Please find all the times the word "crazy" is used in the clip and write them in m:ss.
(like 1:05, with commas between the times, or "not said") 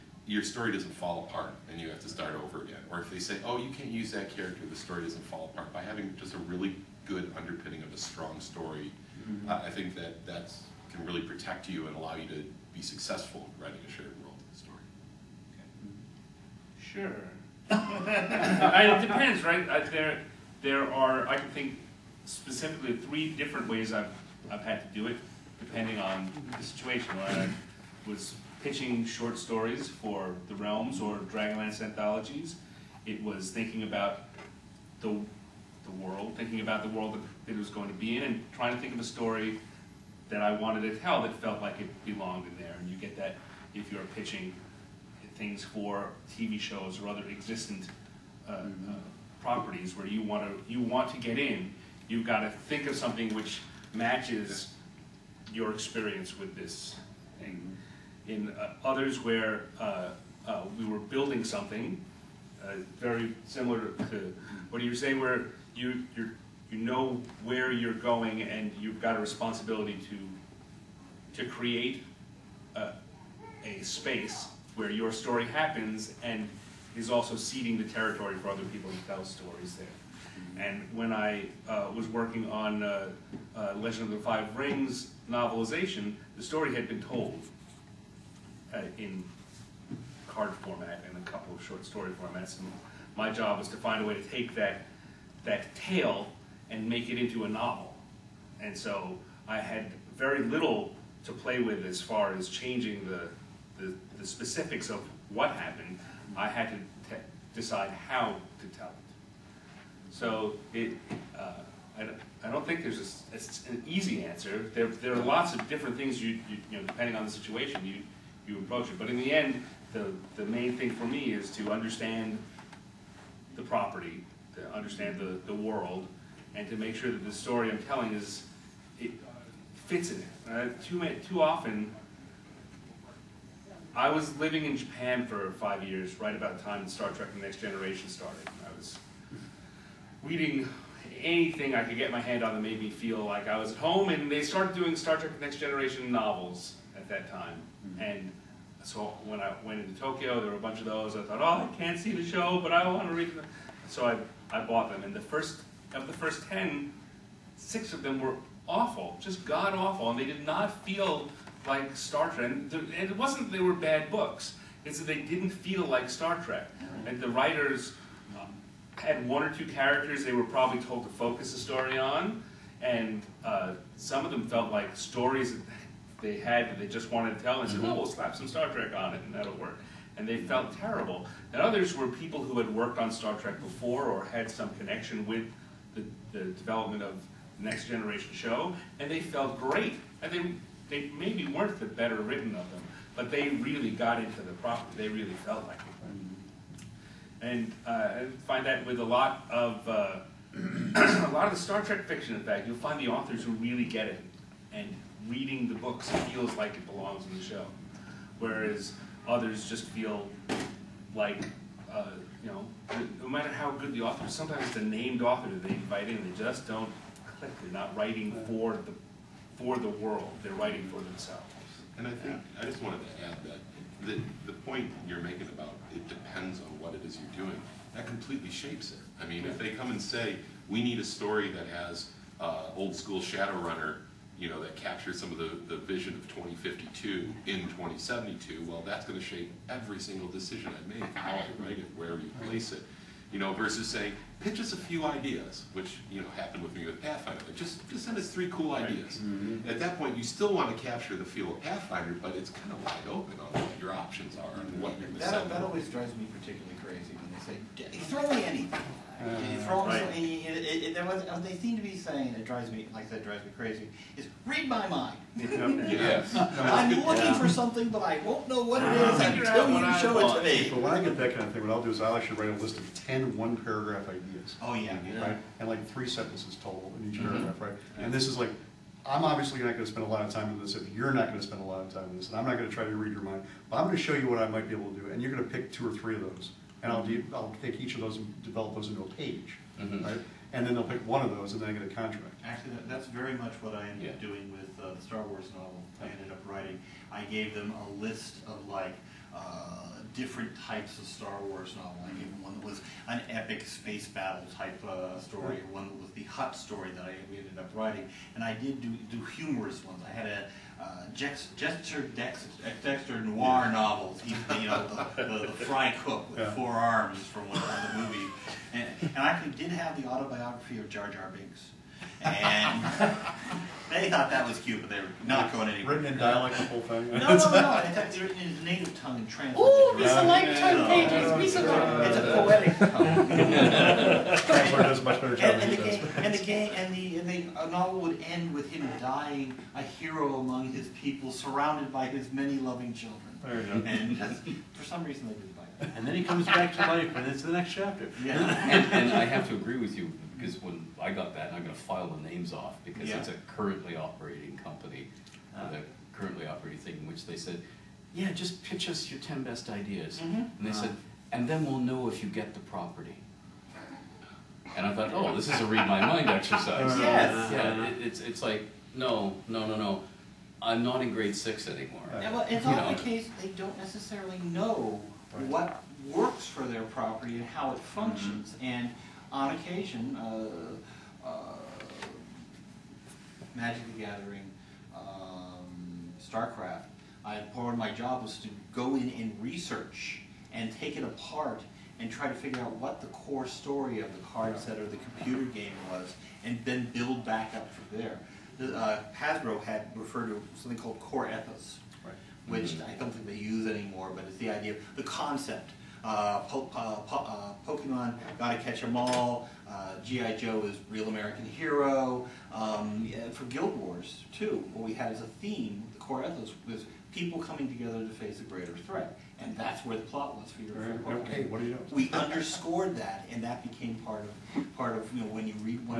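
4:16, 4:23.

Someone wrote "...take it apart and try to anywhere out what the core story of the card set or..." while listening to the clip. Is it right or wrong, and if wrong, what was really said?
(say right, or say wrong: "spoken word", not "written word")
wrong: "figure", not "anywhere".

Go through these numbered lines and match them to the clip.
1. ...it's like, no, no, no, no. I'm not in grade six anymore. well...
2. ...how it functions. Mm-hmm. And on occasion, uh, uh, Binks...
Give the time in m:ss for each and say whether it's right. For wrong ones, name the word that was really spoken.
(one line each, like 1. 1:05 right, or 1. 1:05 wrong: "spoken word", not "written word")
1. 6:08 right
2. 6:17 wrong: "Magic", not "Binks".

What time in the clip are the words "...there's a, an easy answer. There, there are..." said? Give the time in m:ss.
1:52.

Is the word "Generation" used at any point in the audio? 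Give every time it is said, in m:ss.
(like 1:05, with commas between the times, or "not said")
2:17, 2:25, 3:07.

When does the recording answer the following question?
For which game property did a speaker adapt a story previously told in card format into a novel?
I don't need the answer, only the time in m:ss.
1:23.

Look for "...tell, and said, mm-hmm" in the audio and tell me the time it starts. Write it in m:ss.
2:57.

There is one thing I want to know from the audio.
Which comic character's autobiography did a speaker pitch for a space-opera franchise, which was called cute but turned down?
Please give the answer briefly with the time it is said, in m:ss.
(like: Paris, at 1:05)
Jar Jar Binks, at 5:20.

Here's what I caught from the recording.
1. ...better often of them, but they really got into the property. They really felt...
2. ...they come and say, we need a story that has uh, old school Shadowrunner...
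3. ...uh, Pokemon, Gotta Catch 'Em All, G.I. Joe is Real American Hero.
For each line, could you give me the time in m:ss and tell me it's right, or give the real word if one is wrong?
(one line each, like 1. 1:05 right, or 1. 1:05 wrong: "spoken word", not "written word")
1. 3:11 wrong: "written", not "often"
2. 3:49 right
3. 6:47 right.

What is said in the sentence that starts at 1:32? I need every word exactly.
And my job was to find a way to take that, that tale and make it into a novel.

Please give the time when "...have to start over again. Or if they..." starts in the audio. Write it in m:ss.
0:01.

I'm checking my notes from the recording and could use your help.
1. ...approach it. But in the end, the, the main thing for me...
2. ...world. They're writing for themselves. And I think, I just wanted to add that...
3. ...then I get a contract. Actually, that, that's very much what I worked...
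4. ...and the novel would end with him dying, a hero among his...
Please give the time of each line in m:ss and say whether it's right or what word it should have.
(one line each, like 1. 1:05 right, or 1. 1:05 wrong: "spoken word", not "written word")
1. 1:58 right
2. 3:39 right
3. 4:51 wrong: "ended", not "worked"
4. 5:37 right.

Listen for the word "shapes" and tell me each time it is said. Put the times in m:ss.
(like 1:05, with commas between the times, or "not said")
3:48, 3:59.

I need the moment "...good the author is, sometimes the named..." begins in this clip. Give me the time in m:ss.
3:33.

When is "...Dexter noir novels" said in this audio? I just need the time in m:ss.
5:12.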